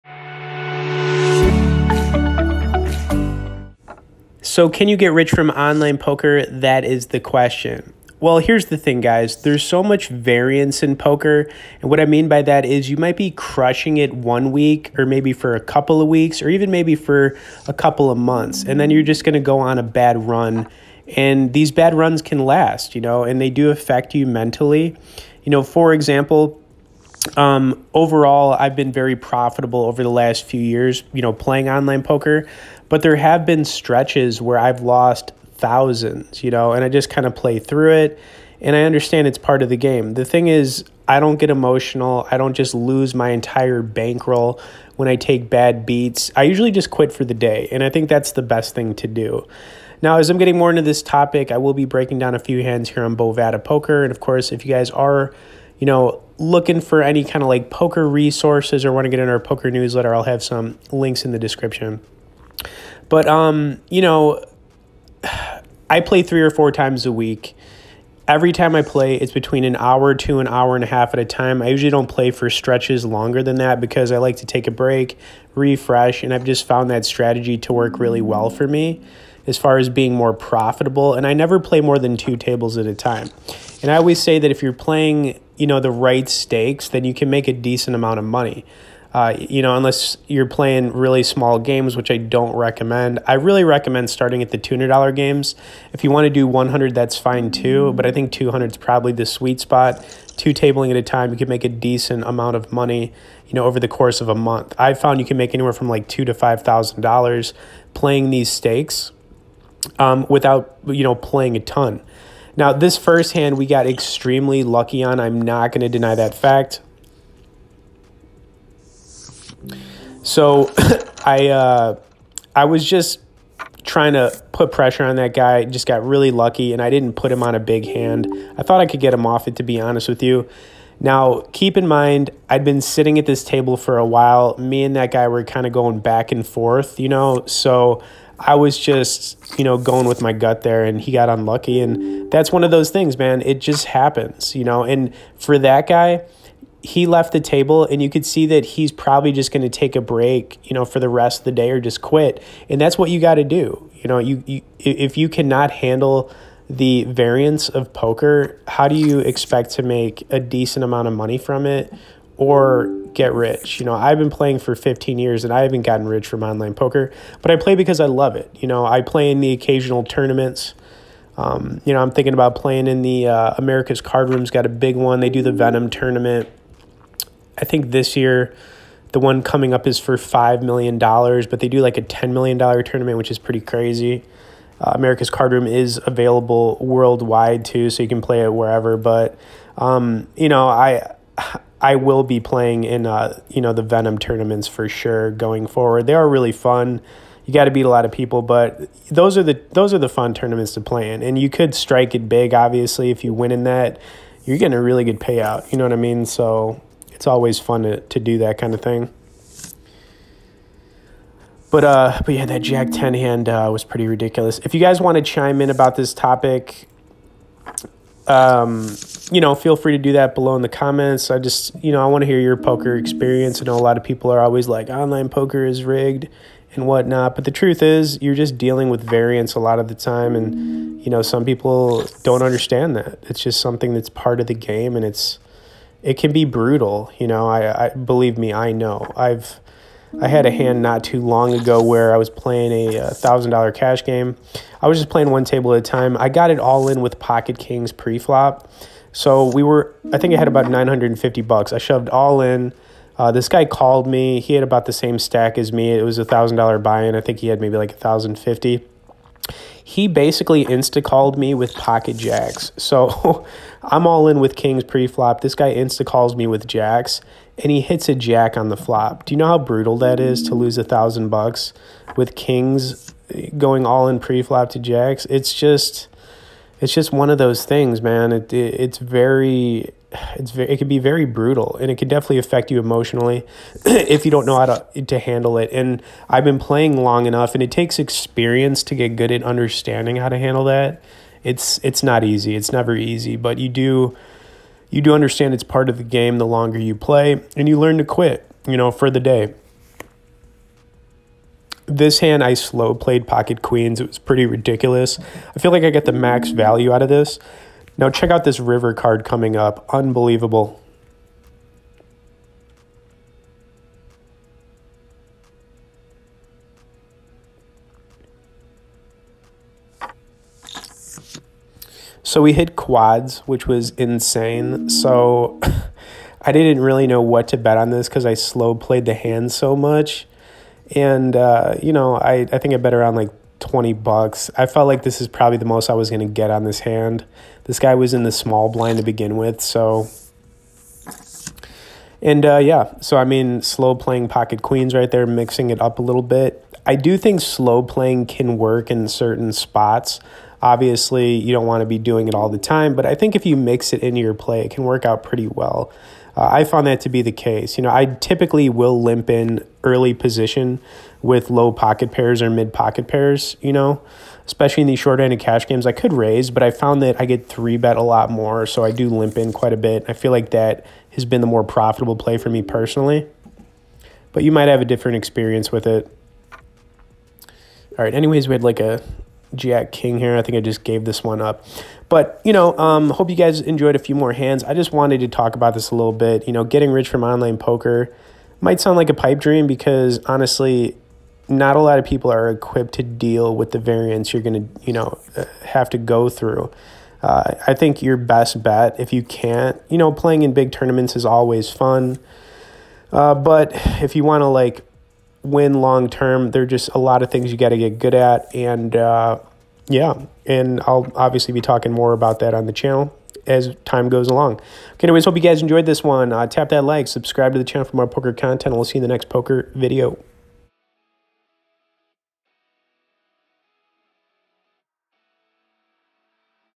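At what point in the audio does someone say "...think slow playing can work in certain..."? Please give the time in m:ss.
5:47.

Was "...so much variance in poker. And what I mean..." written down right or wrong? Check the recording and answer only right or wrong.
right.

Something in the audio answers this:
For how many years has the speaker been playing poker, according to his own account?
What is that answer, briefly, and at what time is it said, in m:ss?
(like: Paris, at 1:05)
15, at 2:44.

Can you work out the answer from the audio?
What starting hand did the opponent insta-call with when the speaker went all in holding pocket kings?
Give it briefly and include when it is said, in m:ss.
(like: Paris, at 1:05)
Pocket jacks, at 4:21.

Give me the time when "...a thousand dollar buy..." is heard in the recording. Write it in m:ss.
4:16.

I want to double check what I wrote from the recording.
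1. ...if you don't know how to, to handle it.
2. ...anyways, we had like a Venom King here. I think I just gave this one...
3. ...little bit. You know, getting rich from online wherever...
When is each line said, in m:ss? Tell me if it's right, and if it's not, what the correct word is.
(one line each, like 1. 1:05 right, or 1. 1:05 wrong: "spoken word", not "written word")
1. 4:43 right
2. 6:18 wrong: "Jack", not "Venom"
3. 6:25 wrong: "poker", not "wherever".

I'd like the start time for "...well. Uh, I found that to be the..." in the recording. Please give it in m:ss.
5:55.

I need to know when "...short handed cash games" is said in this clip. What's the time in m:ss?
6:04.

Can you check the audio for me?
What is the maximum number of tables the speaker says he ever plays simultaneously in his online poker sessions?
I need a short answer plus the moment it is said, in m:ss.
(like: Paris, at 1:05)
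2, at 1:22.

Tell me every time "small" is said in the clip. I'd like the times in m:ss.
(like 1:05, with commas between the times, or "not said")
1:31, 5:38.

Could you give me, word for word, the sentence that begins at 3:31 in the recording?
But uh, but yeah, that Jack Ten hand uh, was pretty ridiculous.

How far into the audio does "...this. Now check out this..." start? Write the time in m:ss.
5:07.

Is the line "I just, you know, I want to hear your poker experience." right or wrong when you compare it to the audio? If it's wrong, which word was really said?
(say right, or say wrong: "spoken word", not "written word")
right.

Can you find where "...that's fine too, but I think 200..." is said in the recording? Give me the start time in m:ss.
1:36.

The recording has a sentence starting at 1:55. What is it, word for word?
I'm not going to deny that fact.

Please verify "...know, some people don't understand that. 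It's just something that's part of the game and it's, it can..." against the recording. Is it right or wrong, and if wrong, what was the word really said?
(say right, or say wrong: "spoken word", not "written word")
right.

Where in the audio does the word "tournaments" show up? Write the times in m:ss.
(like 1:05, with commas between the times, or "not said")
2:50, 2:55, 3:02, 3:14, 3:20, 6:40.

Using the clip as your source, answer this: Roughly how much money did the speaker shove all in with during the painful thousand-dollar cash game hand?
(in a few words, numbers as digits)
$950.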